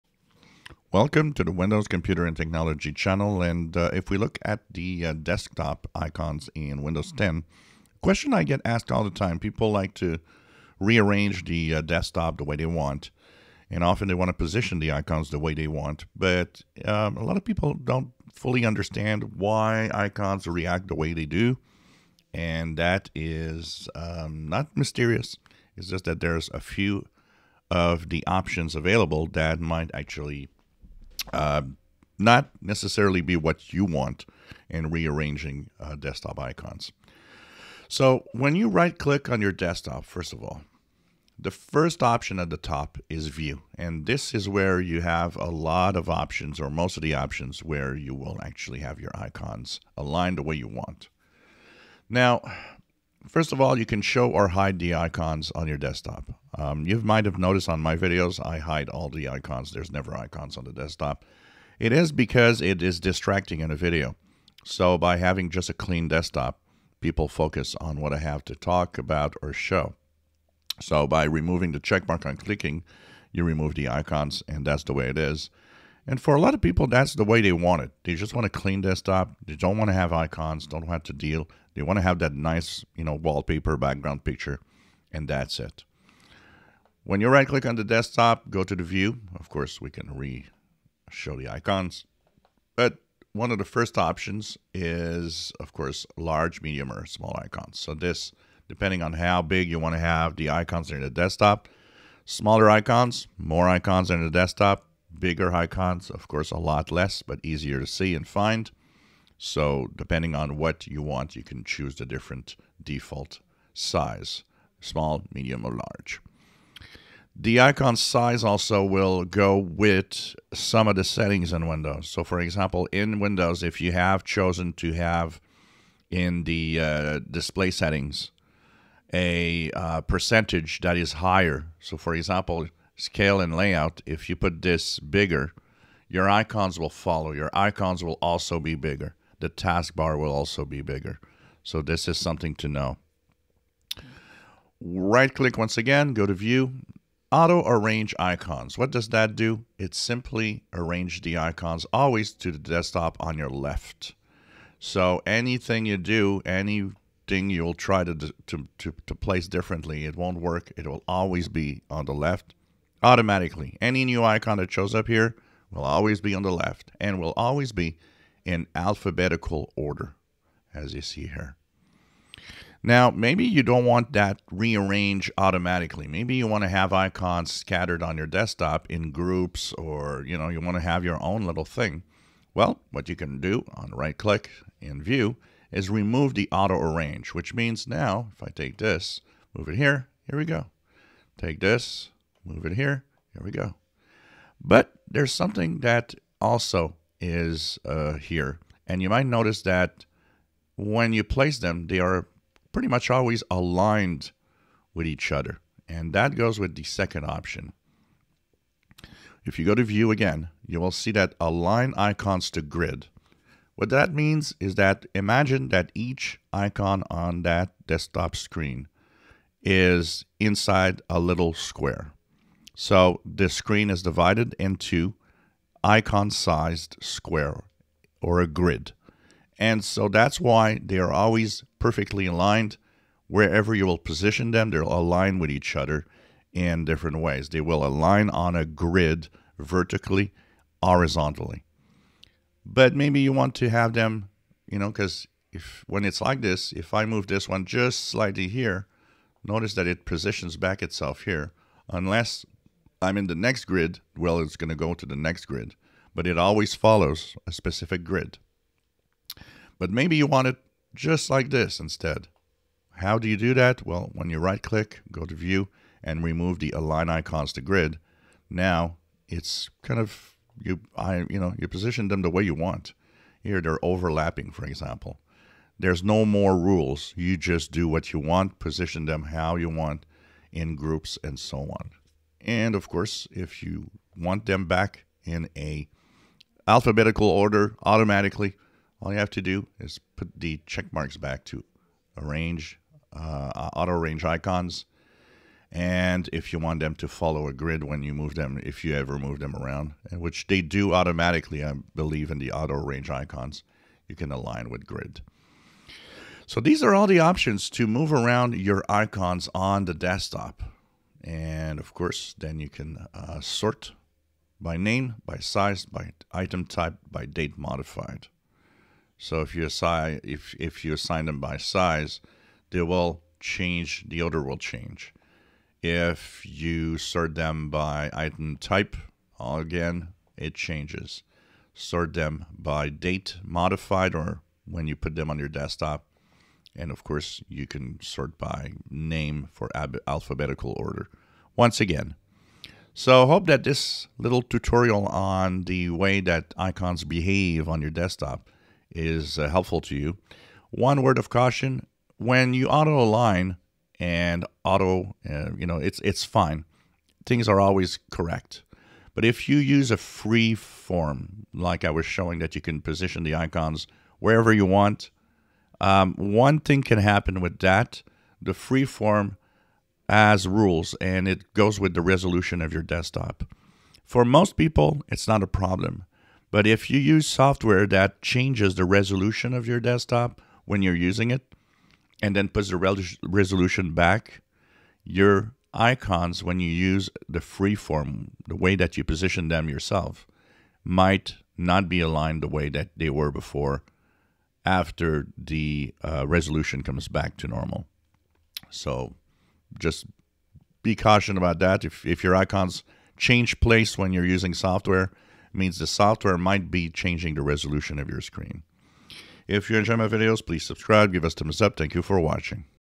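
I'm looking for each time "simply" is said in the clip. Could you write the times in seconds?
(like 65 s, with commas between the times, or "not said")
149 s.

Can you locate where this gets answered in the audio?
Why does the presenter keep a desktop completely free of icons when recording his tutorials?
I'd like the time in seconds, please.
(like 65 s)
62 s.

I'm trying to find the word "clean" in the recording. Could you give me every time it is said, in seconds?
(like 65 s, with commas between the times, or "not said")
65 s, 78 s.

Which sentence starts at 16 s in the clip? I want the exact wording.
But um, a lot of people don't fully understand why icons react the way they do.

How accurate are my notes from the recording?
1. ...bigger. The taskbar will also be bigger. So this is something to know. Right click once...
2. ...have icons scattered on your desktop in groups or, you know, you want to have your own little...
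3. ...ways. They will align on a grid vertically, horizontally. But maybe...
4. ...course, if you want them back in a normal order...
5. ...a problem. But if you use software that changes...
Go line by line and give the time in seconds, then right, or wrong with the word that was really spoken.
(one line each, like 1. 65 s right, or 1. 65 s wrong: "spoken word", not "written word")
1. 138 s right
2. 176 s right
3. 237 s right
4. 282 s wrong: "alphabetical", not "normal"
5. 375 s right.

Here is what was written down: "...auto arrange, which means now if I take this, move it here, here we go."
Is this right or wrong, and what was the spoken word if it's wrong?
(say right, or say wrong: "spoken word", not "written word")
right.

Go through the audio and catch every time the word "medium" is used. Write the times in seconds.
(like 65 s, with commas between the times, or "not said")
96 s, 115 s.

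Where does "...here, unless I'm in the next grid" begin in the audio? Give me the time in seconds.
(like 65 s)
251 s.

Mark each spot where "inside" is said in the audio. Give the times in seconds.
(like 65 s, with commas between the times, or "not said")
220 s.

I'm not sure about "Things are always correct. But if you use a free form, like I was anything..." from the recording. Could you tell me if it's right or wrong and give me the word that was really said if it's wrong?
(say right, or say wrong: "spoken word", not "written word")
wrong: "showing", not "anything".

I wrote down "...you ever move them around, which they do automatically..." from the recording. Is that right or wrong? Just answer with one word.
right.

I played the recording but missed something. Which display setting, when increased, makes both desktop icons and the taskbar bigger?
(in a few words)
Scale and layout.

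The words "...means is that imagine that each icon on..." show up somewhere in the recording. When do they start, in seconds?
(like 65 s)
214 s.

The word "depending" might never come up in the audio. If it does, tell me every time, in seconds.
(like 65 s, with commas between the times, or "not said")
98 s, 109 s.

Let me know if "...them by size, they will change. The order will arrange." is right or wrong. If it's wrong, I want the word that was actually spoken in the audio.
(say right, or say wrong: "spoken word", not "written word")
wrong: "change", not "arrange".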